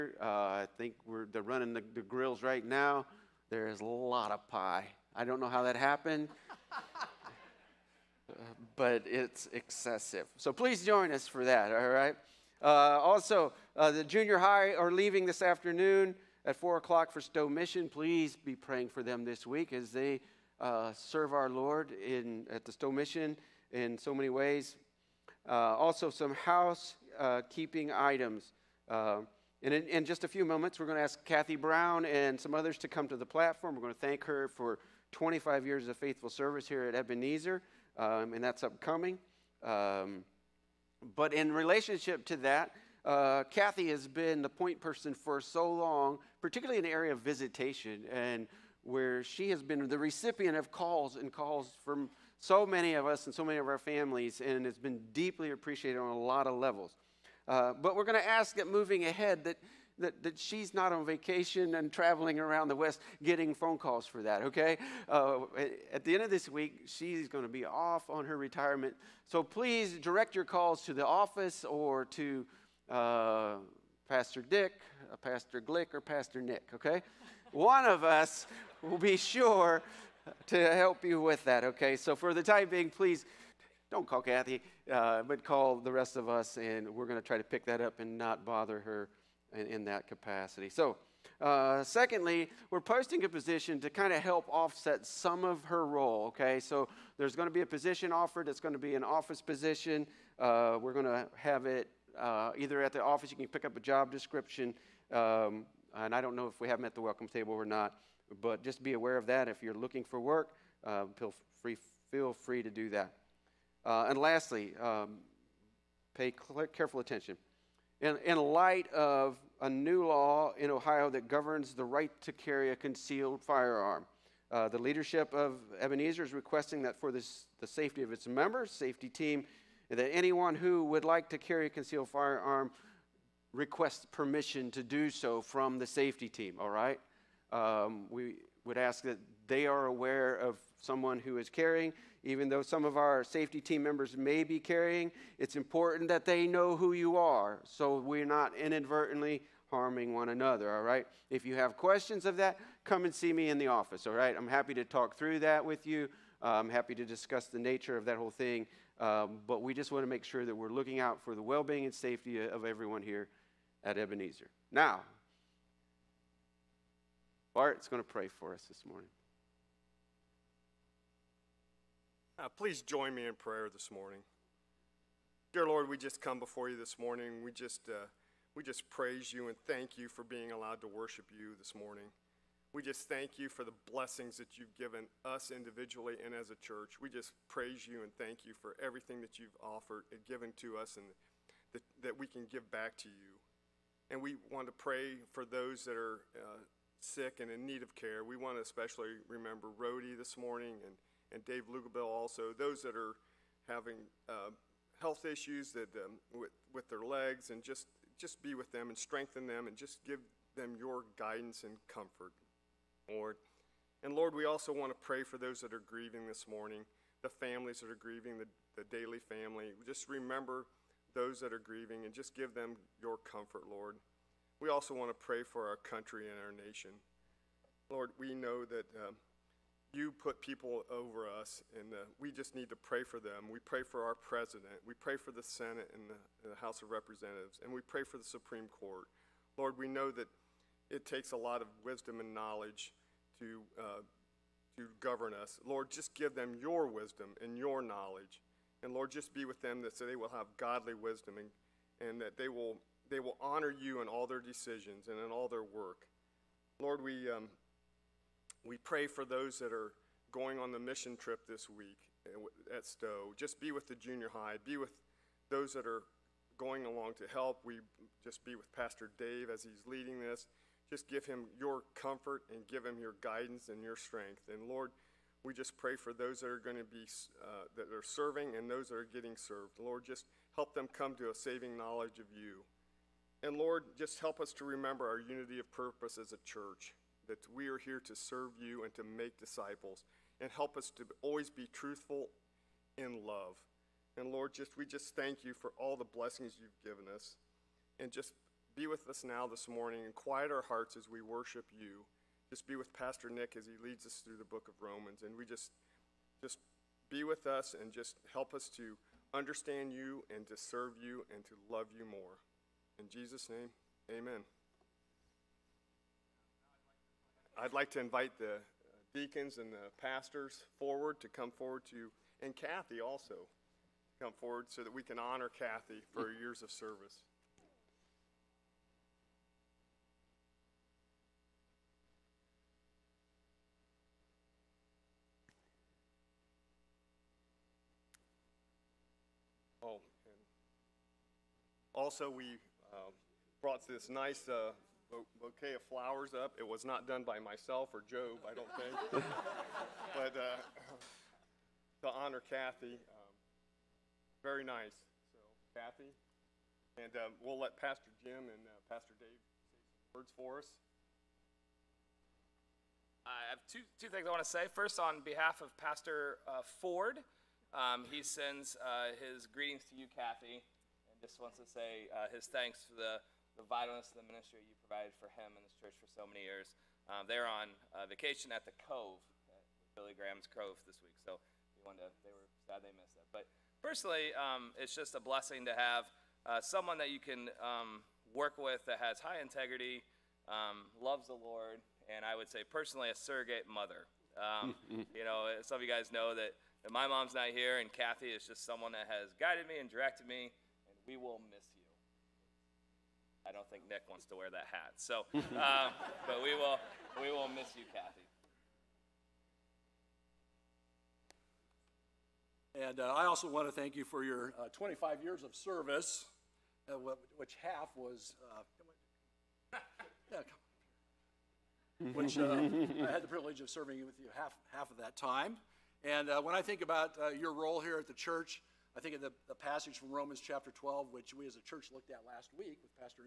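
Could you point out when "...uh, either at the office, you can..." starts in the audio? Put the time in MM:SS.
01:42.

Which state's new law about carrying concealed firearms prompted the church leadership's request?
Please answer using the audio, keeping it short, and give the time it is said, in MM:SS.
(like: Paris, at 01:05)
Ohio, at 02:00.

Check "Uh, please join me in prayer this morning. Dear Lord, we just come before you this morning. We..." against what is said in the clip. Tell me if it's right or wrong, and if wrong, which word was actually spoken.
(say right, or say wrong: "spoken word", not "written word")
right.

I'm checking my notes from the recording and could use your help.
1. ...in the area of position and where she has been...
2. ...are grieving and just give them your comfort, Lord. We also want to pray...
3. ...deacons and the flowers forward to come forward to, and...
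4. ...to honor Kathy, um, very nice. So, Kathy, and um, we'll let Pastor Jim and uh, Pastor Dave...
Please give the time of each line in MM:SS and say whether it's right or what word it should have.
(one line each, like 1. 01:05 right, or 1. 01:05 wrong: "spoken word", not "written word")
1. 00:46 wrong: "visitation", not "position"
2. 03:41 right
3. 05:19 wrong: "pastors", not "flowers"
4. 05:52 right.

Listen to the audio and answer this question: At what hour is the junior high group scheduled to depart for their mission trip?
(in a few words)
4 o'clock.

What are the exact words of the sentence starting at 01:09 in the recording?
So please direct your calls to the office or to.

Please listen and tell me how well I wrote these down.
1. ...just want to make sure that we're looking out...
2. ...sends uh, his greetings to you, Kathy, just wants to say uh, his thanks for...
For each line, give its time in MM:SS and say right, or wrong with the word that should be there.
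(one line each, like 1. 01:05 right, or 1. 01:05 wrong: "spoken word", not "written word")
1. 02:39 right
2. 06:08 right.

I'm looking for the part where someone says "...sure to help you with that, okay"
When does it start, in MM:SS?
01:19.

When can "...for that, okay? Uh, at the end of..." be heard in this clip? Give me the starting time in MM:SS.
01:04.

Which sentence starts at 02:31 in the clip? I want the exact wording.
If you have questions of that, come and see me in the office, all right?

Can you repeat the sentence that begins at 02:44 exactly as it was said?
Now, Bart's going to pray for us this morning.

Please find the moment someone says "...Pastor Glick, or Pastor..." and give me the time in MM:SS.
01:15.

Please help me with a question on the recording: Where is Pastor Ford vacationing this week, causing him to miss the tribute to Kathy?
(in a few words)
Billy Graham's Cove.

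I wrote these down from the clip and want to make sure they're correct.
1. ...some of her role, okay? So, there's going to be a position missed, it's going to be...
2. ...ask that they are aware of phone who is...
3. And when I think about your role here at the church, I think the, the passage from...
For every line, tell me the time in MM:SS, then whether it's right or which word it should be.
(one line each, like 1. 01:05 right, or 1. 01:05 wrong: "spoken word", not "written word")
1. 01:35 wrong: "offered", not "missed"
2. 02:18 wrong: "someone", not "phone"
3. 07:06 right.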